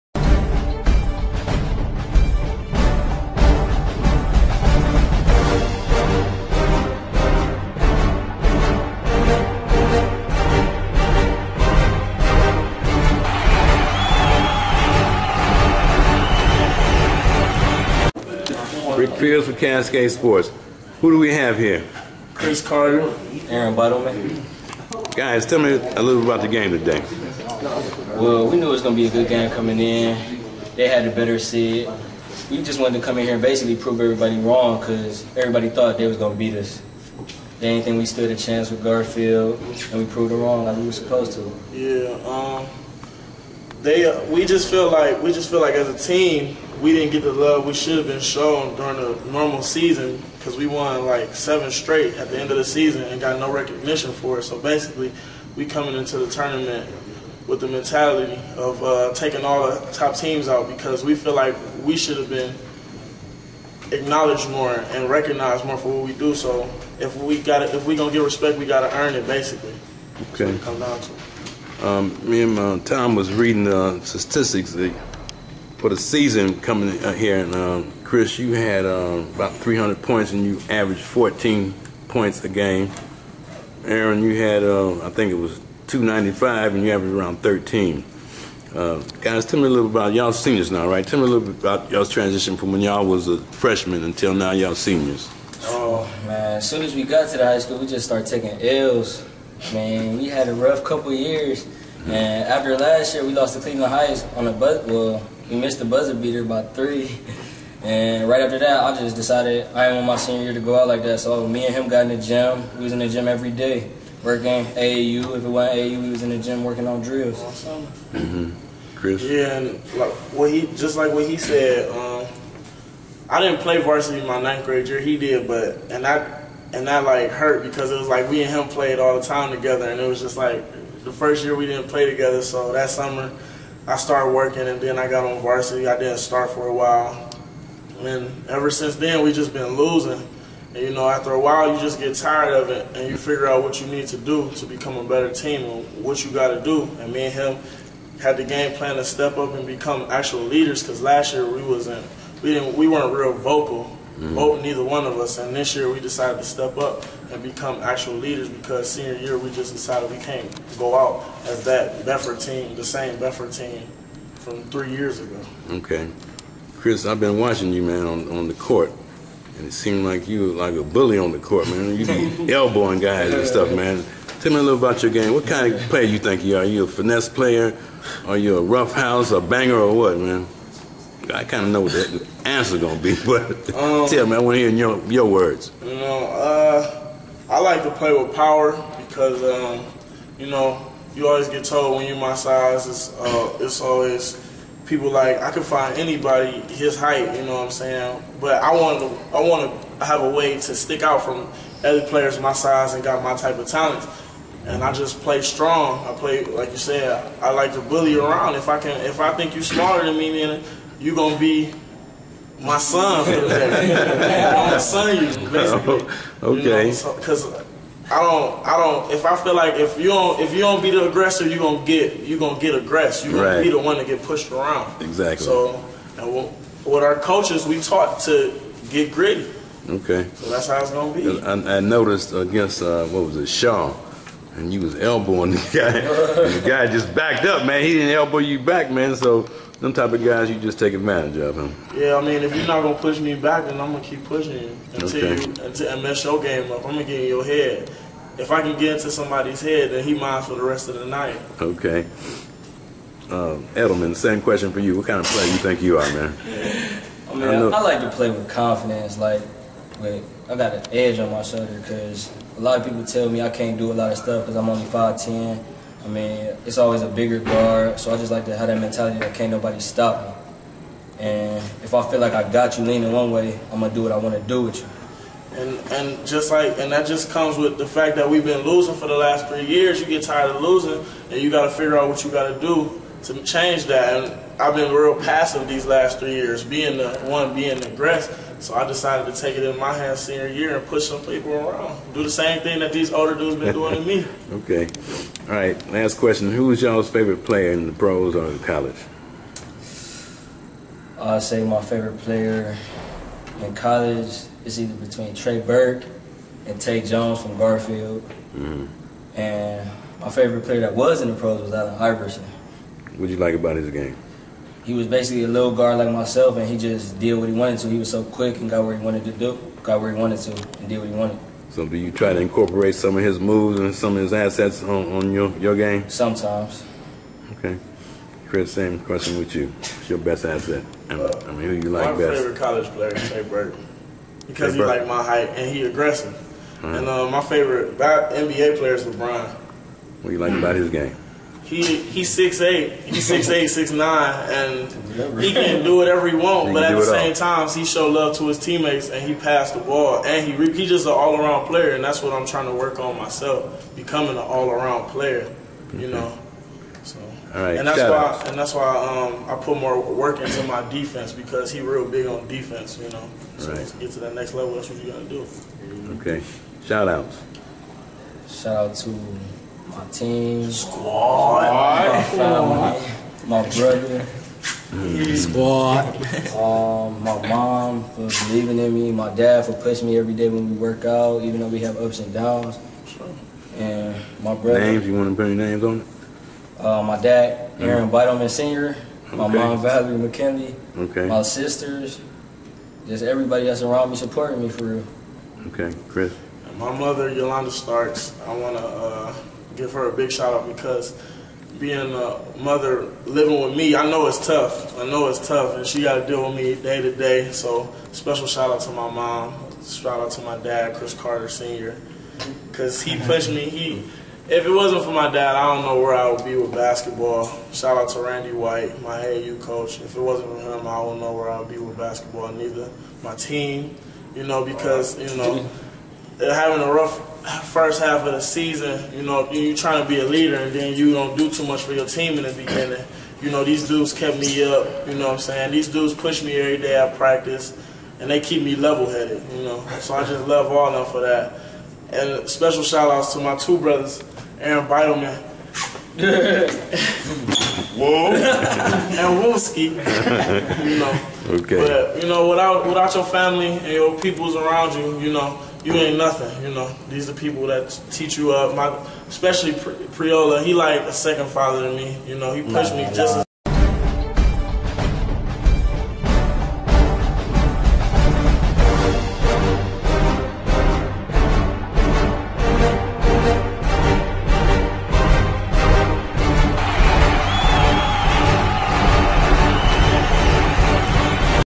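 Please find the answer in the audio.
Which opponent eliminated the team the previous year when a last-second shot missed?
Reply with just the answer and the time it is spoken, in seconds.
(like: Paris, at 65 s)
Cleveland Heights, at 103 s.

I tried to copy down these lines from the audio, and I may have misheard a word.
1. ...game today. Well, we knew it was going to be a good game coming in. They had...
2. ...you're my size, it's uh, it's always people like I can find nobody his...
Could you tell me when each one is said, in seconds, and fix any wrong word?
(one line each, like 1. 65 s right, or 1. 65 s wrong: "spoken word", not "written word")
1. 26 s right
2. 192 s wrong: "anybody", not "nobody".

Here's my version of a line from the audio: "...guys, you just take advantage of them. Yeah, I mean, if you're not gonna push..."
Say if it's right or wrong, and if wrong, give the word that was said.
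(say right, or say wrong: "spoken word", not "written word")
right.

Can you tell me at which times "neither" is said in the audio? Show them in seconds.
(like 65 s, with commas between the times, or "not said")
154 s, 422 s.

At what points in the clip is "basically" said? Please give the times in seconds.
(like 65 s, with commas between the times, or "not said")
33 s, 54 s, 69 s, 215 s, 315 s.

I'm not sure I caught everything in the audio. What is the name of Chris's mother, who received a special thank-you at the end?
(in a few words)
Yolanda Starks.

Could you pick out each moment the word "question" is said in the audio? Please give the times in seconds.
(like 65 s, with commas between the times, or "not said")
254 s, 296 s, 328 s.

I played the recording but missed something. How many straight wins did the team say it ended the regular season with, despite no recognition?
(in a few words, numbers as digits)
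7.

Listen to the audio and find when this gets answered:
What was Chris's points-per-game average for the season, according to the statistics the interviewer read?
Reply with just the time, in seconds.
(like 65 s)
81 s.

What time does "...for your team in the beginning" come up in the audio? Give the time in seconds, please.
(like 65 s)
431 s.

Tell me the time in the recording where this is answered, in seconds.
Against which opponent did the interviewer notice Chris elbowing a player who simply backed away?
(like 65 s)
233 s.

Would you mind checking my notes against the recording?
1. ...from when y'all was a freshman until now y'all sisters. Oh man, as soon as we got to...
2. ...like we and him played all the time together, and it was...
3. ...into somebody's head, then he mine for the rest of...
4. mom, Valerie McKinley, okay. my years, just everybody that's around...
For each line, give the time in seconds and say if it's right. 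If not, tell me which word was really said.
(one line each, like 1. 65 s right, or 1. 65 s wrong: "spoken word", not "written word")
1. 92 s wrong: "seniors", not "sisters"
2. 128 s right
3. 248 s right
4. 389 s wrong: "sisters", not "years".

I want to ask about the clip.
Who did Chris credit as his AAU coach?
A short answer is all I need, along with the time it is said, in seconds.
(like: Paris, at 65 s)
Randy White, at 418 s.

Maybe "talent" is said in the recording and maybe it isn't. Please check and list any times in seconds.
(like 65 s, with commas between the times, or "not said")
203 s.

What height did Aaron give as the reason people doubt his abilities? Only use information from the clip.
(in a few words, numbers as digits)
5'10".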